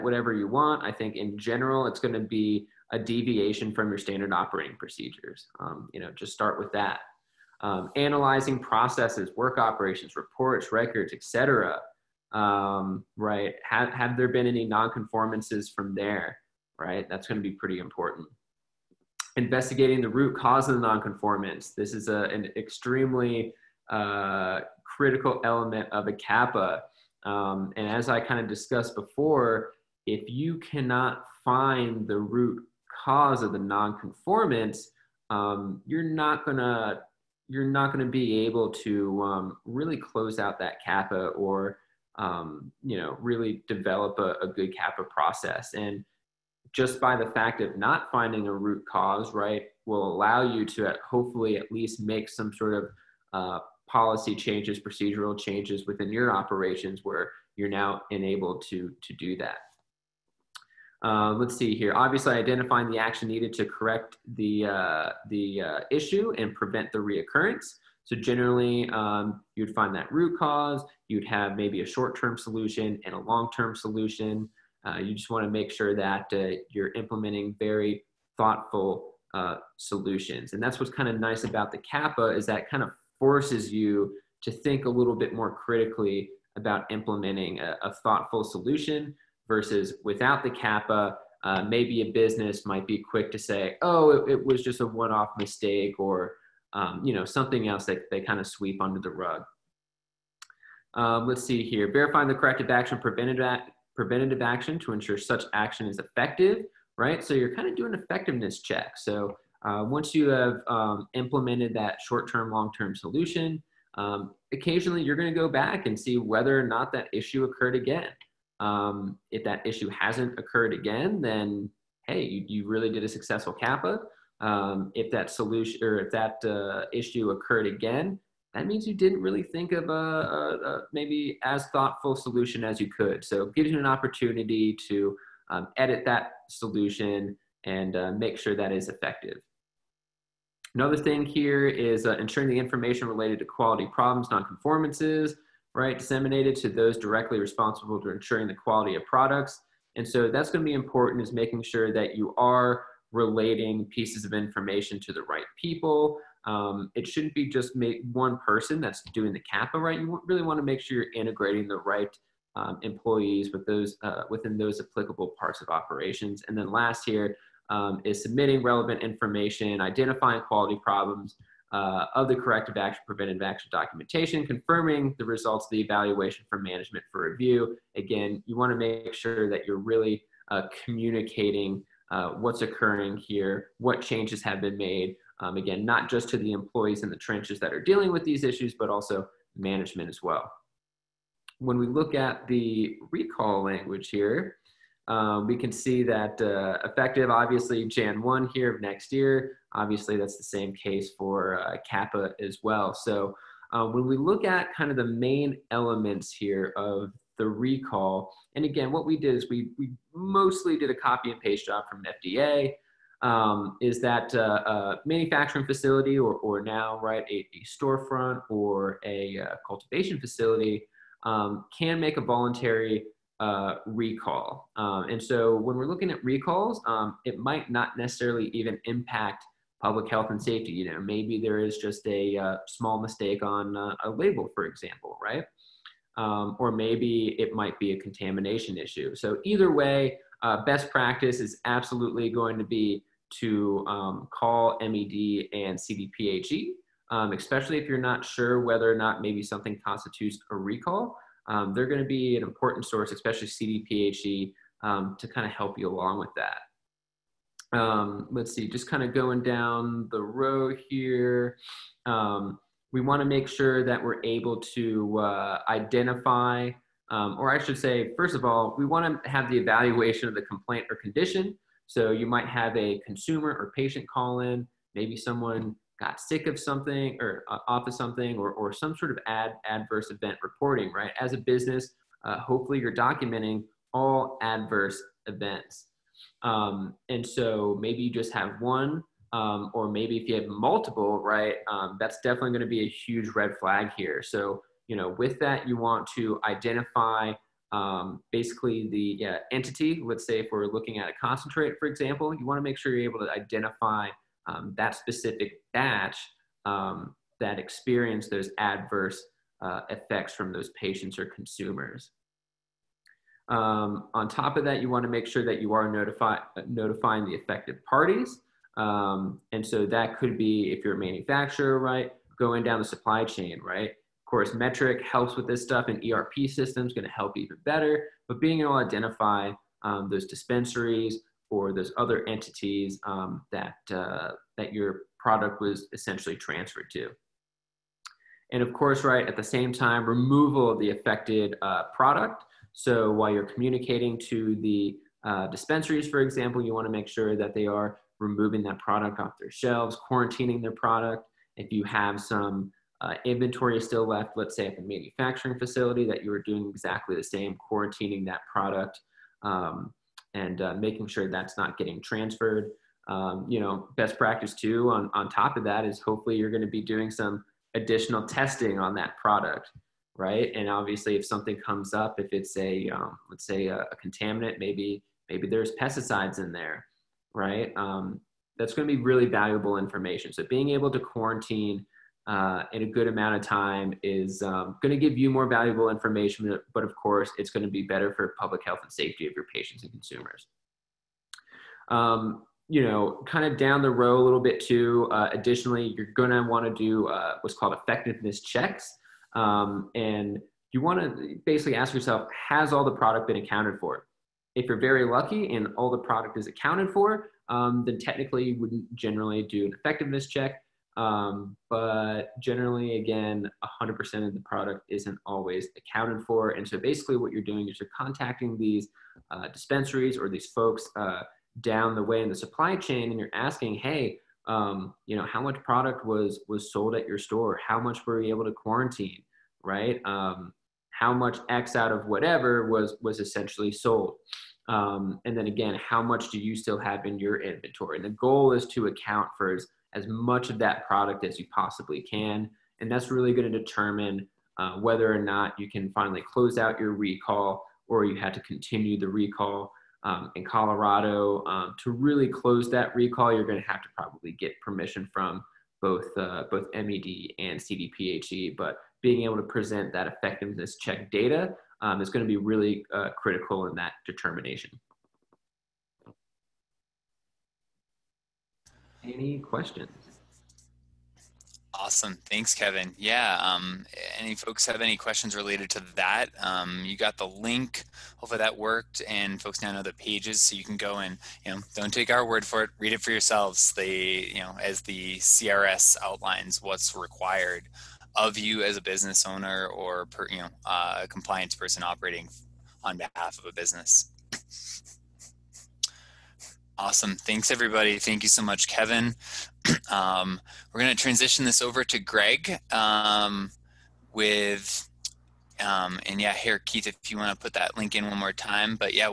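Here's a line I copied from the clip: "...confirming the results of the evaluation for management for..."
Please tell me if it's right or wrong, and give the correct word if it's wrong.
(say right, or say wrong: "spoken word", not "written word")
right.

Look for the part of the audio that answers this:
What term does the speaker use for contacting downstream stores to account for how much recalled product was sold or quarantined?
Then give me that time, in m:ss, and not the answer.
6:37.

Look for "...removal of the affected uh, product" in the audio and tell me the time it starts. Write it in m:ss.
5:40.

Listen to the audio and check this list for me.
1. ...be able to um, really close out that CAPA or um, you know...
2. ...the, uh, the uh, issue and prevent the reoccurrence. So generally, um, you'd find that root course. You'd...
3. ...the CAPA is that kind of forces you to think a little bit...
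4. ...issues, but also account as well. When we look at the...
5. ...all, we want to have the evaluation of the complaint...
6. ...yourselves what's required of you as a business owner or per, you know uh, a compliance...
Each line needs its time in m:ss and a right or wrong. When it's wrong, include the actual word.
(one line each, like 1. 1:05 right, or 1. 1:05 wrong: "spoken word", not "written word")
1. 0:38 right
2. 1:04 wrong: "cause", not "course"
3. 1:21 right
4. 3:08 wrong: "management", not "account"
5. 4:28 right
6. 8:06 wrong: "outlines", not "yourselves".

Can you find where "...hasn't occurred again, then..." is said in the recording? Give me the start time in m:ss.
1:59.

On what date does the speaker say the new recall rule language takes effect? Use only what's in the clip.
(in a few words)
Jan 1.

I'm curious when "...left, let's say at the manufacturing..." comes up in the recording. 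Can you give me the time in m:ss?
5:54.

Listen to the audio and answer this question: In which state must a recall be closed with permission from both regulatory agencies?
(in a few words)
Colorado.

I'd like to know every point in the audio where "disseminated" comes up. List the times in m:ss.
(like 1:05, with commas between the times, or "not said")
2:25.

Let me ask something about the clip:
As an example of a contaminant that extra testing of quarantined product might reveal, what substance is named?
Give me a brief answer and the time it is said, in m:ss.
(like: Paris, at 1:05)
pesticides, at 6:15.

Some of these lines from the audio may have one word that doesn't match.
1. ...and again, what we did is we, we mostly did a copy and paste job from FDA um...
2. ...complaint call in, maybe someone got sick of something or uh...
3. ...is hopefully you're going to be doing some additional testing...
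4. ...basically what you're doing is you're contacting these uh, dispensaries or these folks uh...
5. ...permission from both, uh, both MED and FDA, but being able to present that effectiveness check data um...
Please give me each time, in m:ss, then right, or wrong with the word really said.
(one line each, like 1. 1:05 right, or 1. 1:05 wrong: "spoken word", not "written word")
1. 3:28 right
2. 4:33 wrong: "patient", not "complaint"
3. 6:05 right
4. 6:56 right
5. 7:34 wrong: "CDPHE", not "FDA".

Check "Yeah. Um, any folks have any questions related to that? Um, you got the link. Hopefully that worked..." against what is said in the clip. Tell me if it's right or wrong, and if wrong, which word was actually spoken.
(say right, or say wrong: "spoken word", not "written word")
right.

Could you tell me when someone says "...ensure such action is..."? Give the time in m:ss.
1:44.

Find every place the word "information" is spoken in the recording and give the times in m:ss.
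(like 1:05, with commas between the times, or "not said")
2:22, 2:34, 2:49, 6:19, 6:25.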